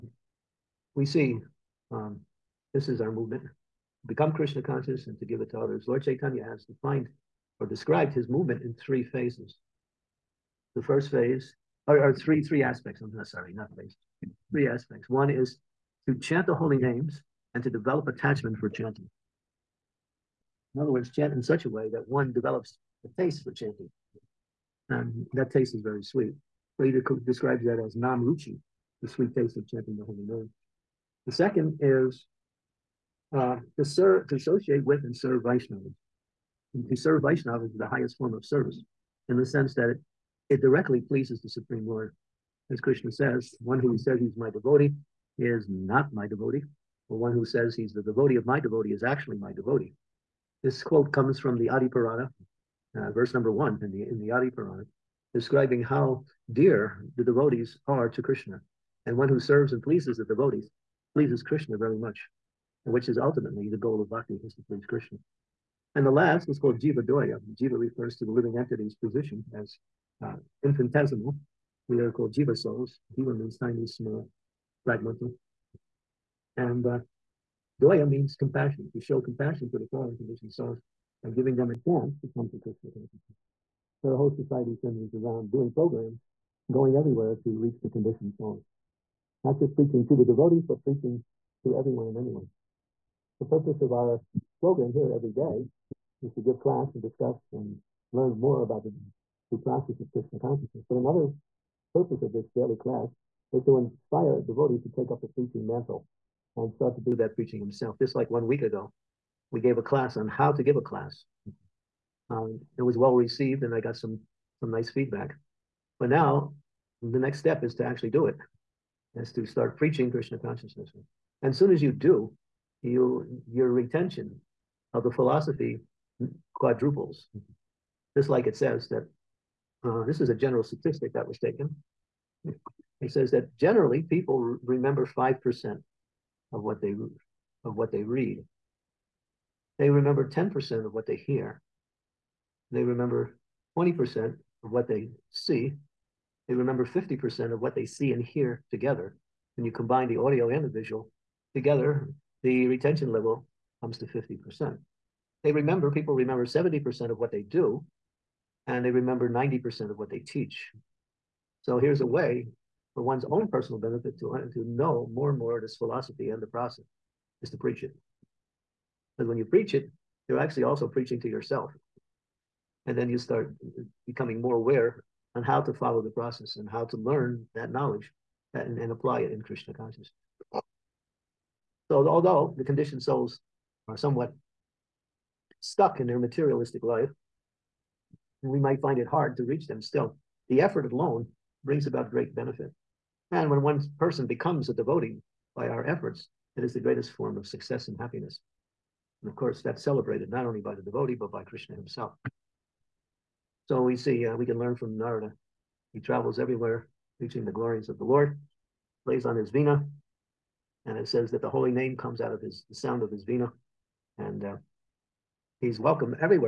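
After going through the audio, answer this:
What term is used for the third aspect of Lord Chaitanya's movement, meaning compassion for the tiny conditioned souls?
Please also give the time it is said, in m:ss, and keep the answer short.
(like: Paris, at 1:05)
jiva doya, at 1:06.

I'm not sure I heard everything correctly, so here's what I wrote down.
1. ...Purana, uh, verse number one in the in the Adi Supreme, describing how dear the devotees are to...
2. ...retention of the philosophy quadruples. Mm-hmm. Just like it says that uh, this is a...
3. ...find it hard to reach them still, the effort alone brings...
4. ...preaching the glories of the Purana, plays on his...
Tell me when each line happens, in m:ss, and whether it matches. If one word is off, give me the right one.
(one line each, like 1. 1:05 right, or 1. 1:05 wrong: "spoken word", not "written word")
1. 0:51 wrong: "Purana", not "Supreme"
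2. 2:03 right
3. 3:08 right
4. 3:27 wrong: "Lord", not "Purana".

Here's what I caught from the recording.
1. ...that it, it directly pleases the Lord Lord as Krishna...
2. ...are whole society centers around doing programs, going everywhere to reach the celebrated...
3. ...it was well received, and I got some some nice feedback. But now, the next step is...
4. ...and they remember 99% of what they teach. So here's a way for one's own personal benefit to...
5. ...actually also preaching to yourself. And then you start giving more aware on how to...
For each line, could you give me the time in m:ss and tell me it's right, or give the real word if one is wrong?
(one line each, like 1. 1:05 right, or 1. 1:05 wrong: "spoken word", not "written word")
1. 0:39 wrong: "Supreme", not "Lord"
2. 1:24 wrong: "conditioned", not "celebrated"
3. 1:52 right
4. 2:38 wrong: "90", not "99"
5. 2:50 wrong: "becoming", not "giving".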